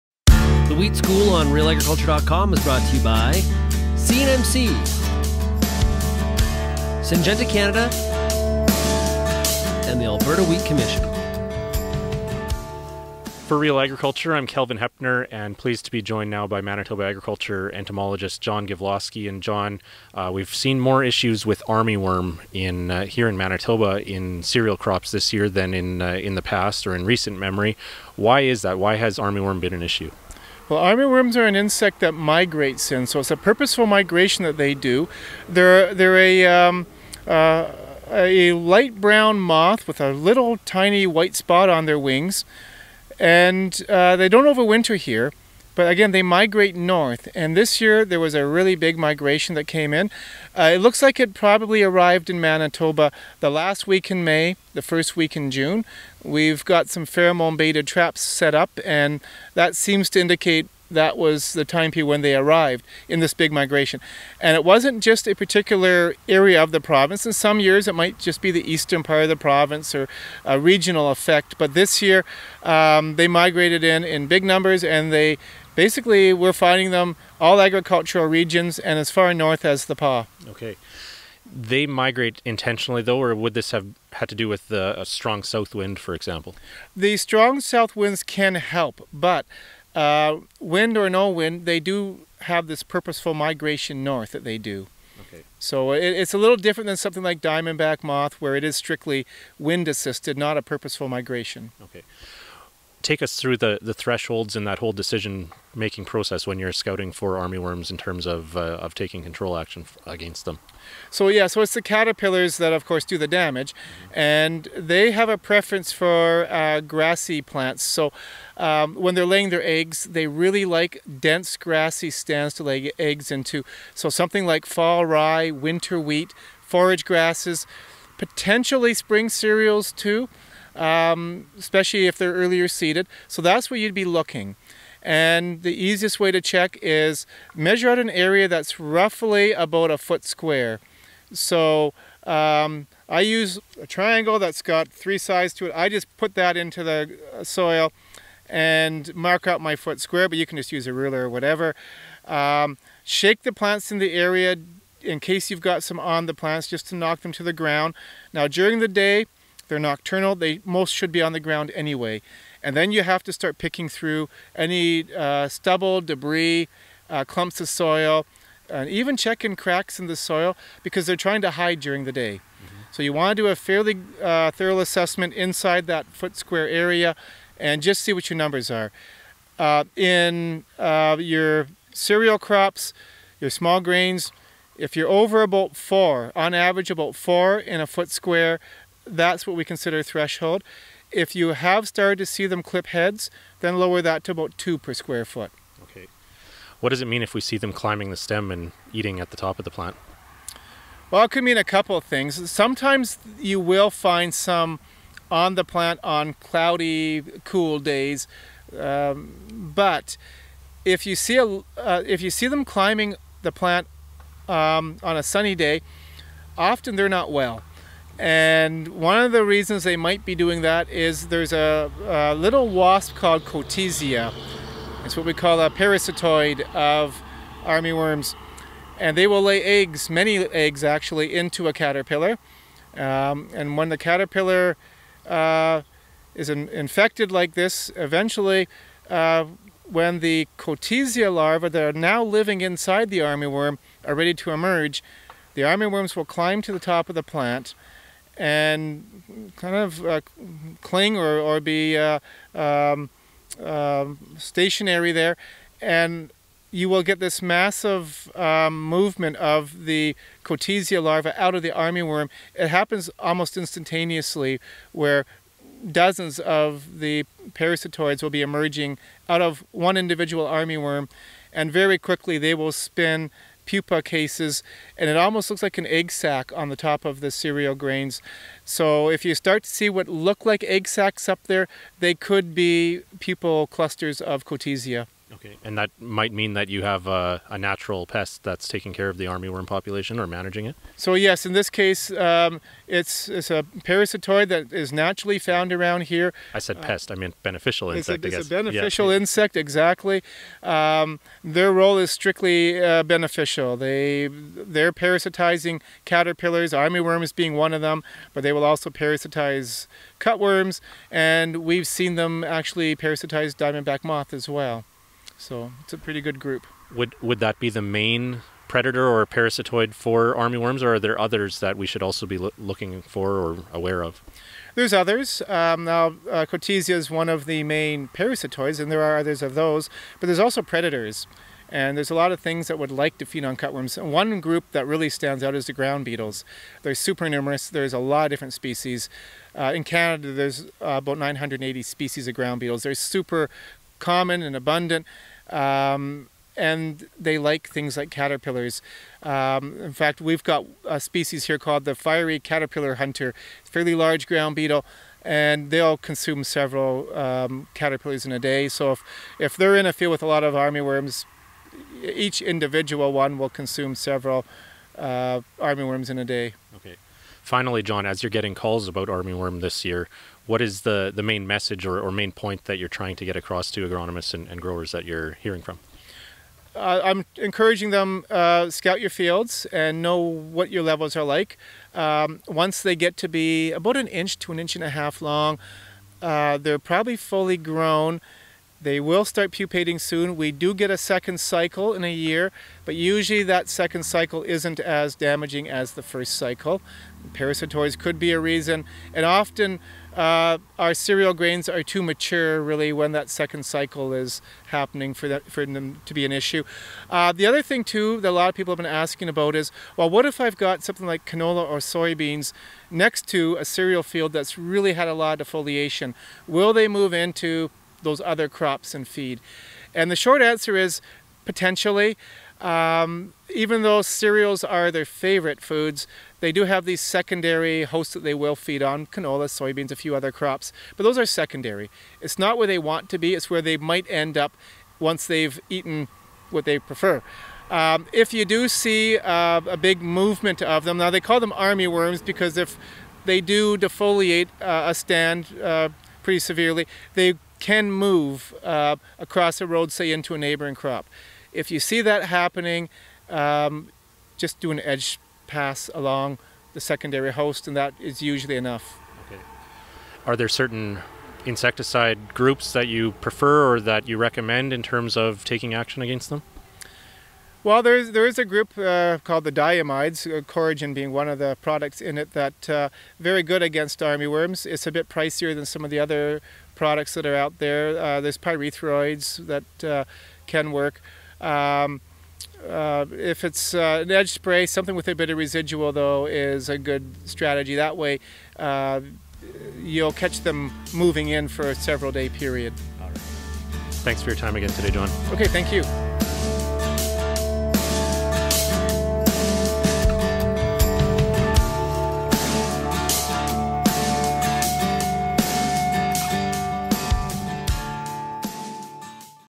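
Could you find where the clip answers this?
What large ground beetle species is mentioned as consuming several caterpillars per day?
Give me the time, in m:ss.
5:51.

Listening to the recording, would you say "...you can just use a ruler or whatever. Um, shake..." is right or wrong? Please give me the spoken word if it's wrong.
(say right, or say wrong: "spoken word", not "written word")
right.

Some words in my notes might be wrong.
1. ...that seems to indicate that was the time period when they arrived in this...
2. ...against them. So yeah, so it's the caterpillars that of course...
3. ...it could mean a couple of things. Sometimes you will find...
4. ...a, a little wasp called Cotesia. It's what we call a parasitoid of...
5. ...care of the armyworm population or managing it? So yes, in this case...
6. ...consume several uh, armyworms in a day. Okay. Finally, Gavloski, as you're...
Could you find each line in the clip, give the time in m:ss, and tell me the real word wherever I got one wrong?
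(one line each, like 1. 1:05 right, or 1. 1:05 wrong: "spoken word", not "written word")
1. 0:59 right
2. 1:50 right
3. 3:21 right
4. 3:41 right
5. 4:48 right
6. 6:03 wrong: "John", not "Gavloski".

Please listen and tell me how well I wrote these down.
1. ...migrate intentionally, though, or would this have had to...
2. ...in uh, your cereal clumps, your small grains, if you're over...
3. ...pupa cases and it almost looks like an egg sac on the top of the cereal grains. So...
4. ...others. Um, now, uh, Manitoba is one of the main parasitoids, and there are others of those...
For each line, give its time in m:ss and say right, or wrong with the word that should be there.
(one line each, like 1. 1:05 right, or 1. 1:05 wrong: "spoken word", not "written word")
1. 1:21 right
2. 2:59 wrong: "crops", not "clumps"
3. 4:33 right
4. 5:24 wrong: "Cotesia", not "Manitoba".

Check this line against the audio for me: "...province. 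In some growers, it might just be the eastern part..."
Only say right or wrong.
wrong.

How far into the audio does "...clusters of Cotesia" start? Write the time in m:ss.
4:43.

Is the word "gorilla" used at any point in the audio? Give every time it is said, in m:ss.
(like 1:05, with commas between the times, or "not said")
not said.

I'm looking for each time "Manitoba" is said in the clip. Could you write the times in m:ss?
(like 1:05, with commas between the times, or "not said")
0:16, 0:23, 0:52.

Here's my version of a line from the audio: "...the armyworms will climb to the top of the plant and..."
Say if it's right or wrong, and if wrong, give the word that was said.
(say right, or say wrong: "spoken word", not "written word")
right.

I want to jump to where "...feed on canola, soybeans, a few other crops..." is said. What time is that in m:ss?
7:08.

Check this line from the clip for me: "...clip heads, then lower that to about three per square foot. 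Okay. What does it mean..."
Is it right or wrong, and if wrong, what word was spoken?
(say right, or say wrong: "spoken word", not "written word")
wrong: "two", not "three".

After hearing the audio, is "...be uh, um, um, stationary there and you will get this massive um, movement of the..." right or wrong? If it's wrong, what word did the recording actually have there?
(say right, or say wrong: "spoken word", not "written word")
right.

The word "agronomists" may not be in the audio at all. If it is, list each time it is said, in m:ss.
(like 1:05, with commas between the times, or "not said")
6:13.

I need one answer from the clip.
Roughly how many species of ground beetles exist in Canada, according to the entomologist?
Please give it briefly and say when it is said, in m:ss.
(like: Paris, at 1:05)
980, at 5:40.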